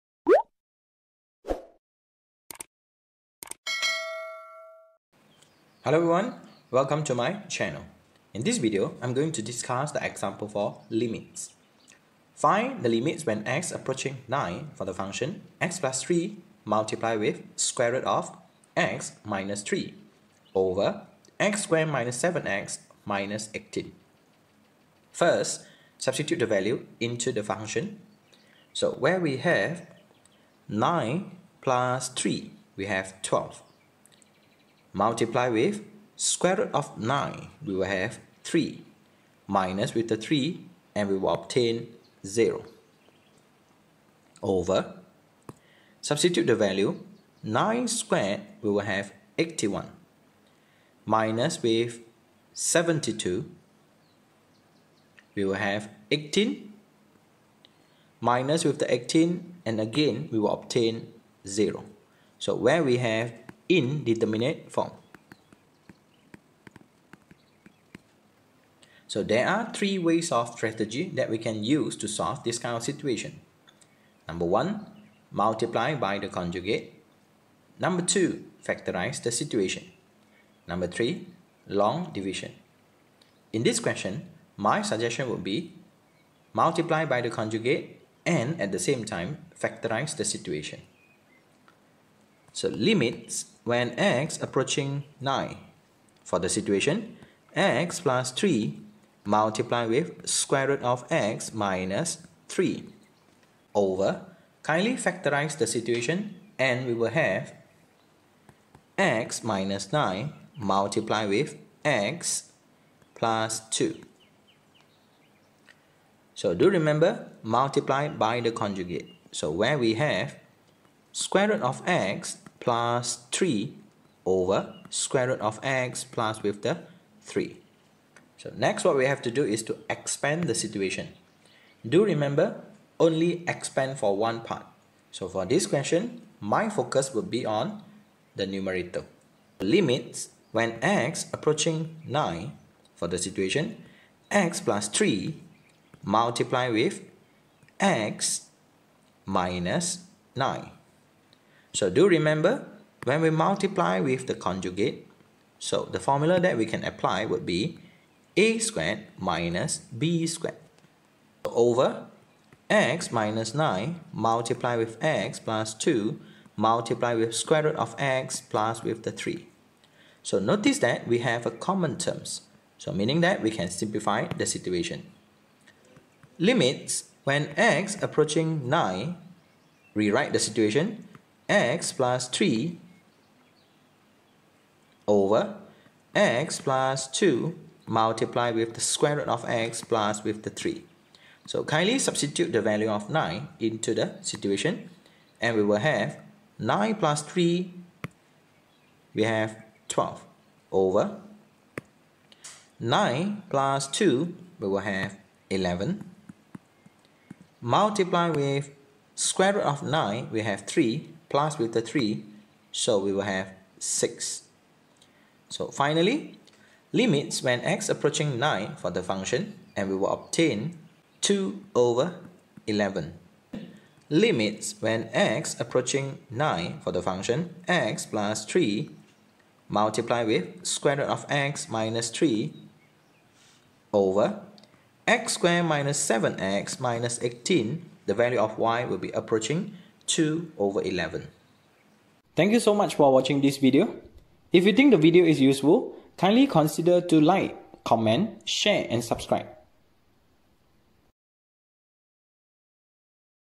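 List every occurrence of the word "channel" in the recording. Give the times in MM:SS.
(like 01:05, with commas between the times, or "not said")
00:07.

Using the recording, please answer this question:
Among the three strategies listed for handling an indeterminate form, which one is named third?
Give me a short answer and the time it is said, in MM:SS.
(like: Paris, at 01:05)
Long division, at 01:21.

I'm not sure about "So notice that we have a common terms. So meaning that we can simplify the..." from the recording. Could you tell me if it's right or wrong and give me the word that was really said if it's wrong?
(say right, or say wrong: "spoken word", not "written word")
right.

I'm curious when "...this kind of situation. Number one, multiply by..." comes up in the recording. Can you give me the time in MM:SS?
01:12.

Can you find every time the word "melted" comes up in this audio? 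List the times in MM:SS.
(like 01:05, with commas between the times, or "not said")
not said.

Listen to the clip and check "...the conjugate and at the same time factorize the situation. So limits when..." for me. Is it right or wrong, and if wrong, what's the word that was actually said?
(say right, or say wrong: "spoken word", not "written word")
right.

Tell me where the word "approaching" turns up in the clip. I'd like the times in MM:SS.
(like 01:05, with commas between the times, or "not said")
00:13, 01:34, 02:21, 02:58, 03:37, 03:45, 03:59.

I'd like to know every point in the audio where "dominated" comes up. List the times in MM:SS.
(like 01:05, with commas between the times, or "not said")
not said.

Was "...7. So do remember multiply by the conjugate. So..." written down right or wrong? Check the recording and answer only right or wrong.
wrong.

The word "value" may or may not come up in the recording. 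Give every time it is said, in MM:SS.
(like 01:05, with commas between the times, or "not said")
00:26, 00:46, 03:12, 03:58.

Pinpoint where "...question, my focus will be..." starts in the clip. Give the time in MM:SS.
02:15.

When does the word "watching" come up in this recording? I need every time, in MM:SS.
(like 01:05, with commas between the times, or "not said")
04:03.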